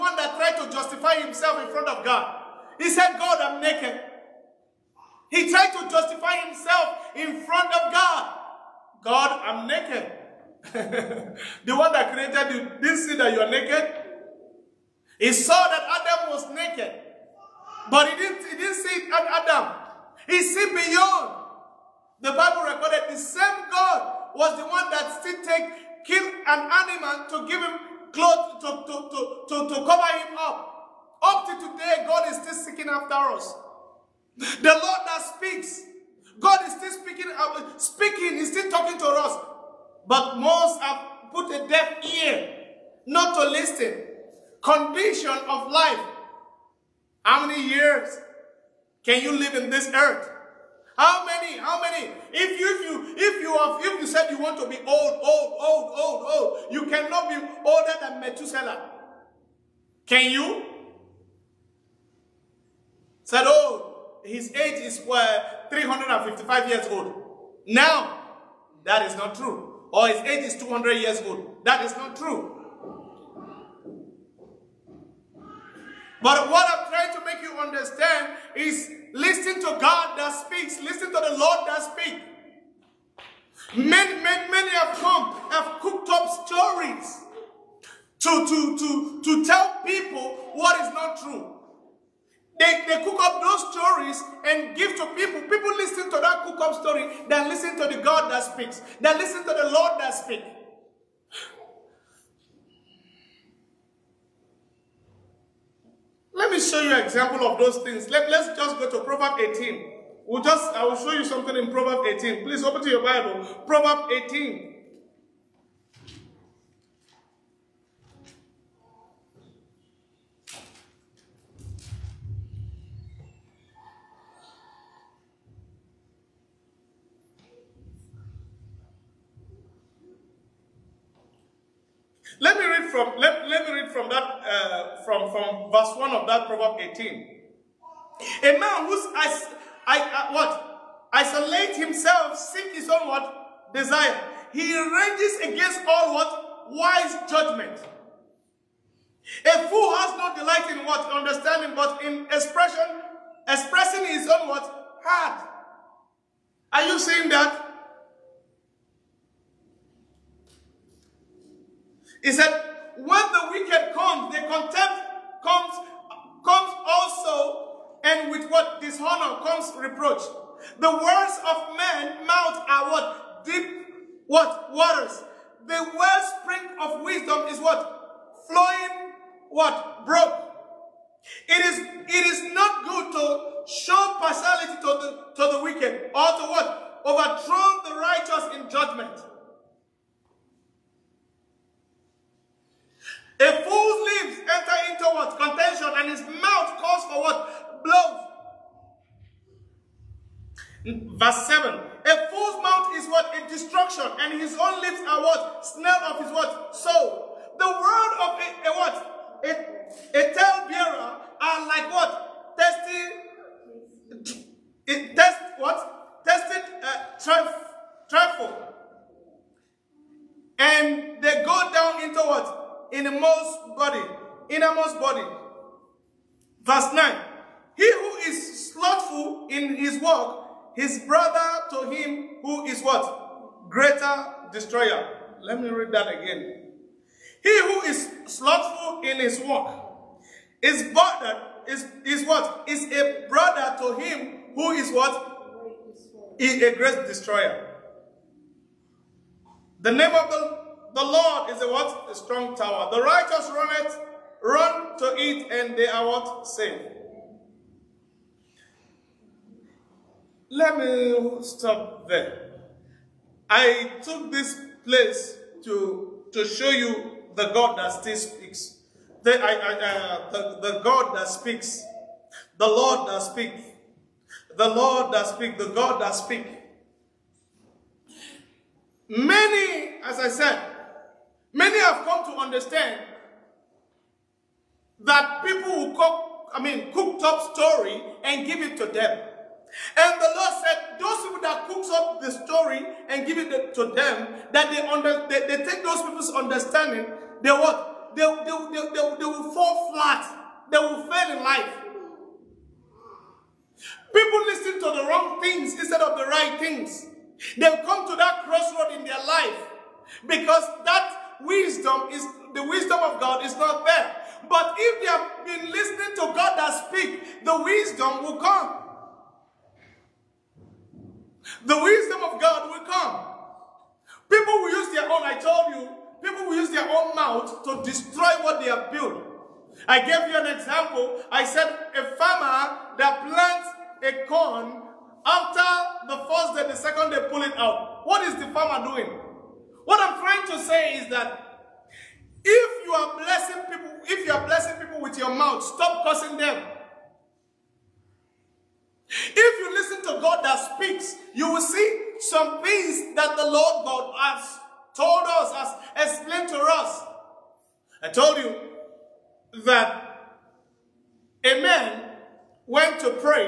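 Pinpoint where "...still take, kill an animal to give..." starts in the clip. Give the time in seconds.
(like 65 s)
25 s.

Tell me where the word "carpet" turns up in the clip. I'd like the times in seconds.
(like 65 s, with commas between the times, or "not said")
not said.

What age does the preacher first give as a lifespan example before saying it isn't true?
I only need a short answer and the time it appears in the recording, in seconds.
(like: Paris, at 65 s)
355 years, at 65 s.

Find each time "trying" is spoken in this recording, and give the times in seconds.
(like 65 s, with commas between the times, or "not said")
76 s, 340 s.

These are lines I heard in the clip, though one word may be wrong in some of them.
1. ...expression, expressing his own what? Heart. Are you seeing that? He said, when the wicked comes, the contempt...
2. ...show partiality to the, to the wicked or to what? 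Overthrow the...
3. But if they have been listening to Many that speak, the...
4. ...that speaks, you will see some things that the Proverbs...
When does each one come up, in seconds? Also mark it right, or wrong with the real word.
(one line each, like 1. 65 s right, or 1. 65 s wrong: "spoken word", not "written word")
1. 152 s right
2. 183 s right
3. 314 s wrong: "God", not "Many"
4. 350 s wrong: "Lord", not "Proverbs".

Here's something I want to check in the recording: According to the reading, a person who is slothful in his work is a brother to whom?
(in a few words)
A great destroyer.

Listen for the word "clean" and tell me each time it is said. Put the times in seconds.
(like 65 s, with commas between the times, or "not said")
not said.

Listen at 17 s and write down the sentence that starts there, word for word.
But he didn't, he didn't see it at Adam.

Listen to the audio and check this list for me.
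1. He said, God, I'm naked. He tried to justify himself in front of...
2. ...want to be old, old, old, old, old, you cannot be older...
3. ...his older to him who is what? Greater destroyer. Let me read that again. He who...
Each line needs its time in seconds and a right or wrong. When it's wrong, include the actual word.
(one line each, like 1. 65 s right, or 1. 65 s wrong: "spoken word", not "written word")
1. 2 s right
2. 54 s right
3. 230 s wrong: "brother", not "older".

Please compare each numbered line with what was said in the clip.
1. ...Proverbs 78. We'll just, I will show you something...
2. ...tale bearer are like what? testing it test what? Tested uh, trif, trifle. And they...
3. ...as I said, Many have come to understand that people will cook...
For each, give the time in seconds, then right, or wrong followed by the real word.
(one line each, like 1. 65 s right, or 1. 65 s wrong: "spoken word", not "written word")
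1. 109 s wrong: "18", not "78"
2. 210 s right
3. 280 s right.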